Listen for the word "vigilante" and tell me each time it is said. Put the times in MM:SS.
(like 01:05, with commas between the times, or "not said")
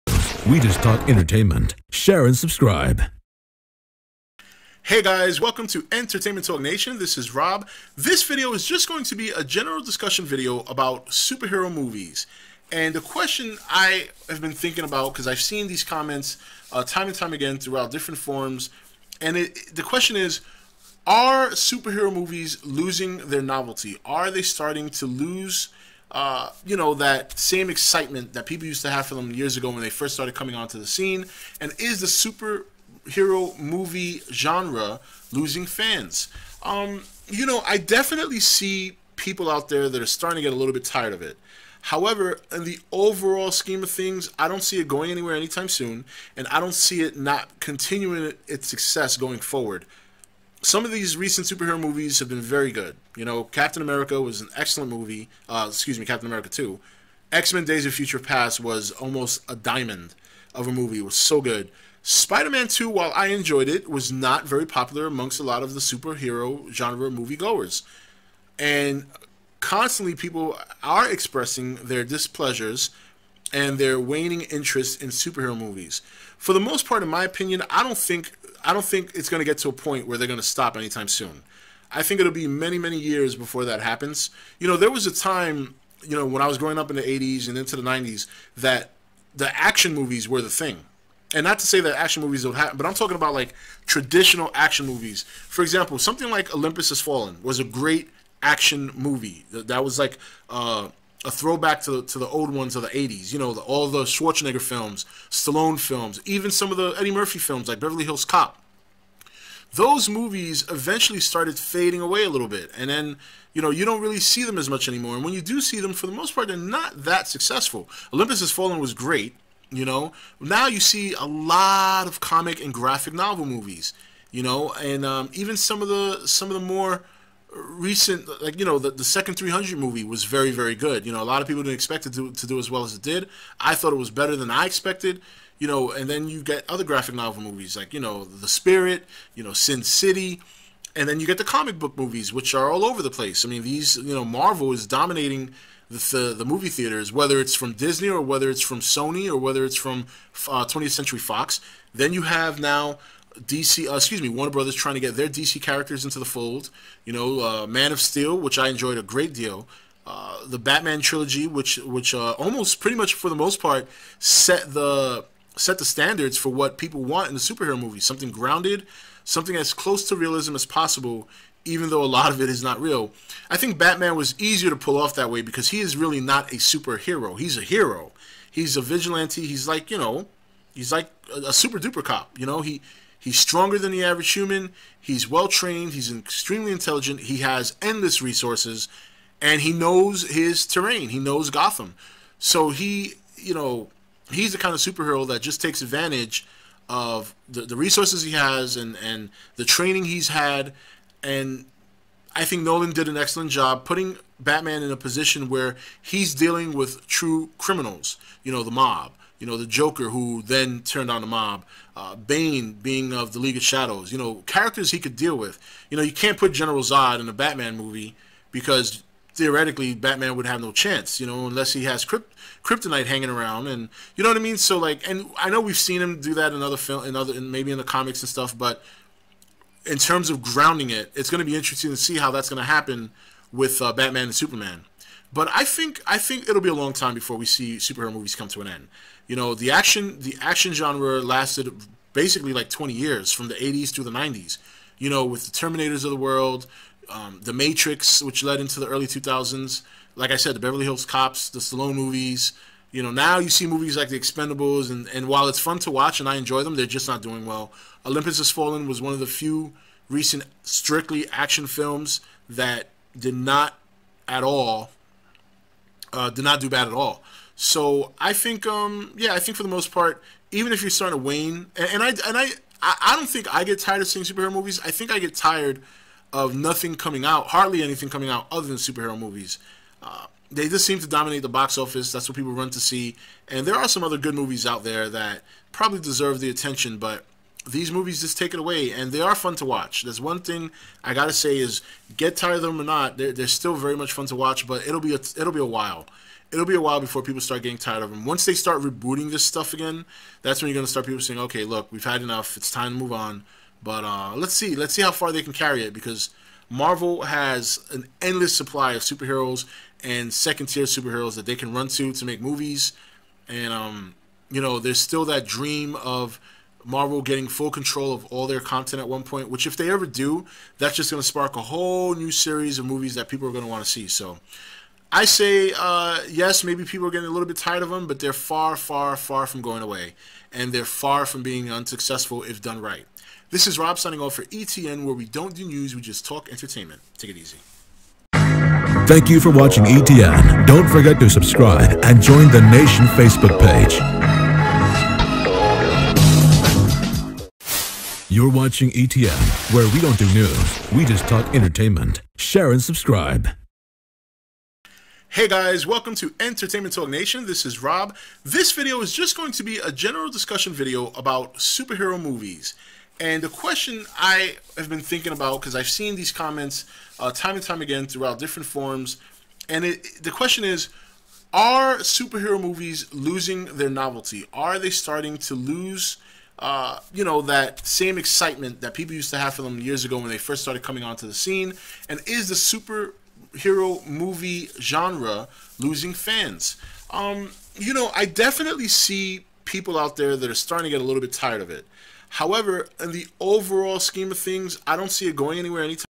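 02:58.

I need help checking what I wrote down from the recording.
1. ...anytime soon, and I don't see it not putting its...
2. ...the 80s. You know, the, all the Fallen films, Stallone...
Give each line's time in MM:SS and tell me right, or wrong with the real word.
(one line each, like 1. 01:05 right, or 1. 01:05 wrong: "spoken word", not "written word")
1. 00:45 wrong: "continuing", not "putting"
2. 01:42 wrong: "Schwarzenegger", not "Fallen".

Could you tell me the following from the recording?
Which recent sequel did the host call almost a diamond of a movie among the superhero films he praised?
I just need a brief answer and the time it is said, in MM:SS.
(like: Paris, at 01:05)
X Men Days of Future Past, at 00:57.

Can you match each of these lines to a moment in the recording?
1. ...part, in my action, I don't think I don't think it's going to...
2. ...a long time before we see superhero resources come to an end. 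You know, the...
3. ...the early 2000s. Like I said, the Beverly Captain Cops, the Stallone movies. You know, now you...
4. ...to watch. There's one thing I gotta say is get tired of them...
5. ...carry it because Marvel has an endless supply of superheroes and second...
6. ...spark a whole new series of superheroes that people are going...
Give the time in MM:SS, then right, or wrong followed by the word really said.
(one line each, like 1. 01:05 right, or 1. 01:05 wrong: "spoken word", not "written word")
1. 01:16 wrong: "opinion", not "action"
2. 03:56 wrong: "movies", not "resources"
3. 04:08 wrong: "Hills", not "Captain"
4. 04:49 right
5. 05:05 right
6. 05:21 wrong: "movies", not "superheroes".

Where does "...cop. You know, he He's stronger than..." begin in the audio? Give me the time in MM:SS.
03:02.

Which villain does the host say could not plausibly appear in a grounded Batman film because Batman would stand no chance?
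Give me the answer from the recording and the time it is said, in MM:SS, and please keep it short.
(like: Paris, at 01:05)
General Zod, at 03:36.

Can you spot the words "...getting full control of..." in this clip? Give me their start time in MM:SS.
05:17.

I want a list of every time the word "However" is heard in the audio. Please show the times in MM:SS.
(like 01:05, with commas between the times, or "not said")
00:41, 06:32.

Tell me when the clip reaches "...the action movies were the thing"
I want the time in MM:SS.
01:29.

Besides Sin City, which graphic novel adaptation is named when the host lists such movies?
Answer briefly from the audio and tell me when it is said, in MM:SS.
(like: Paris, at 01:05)
The Spirit, at 02:18.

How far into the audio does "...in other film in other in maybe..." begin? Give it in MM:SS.
03:46.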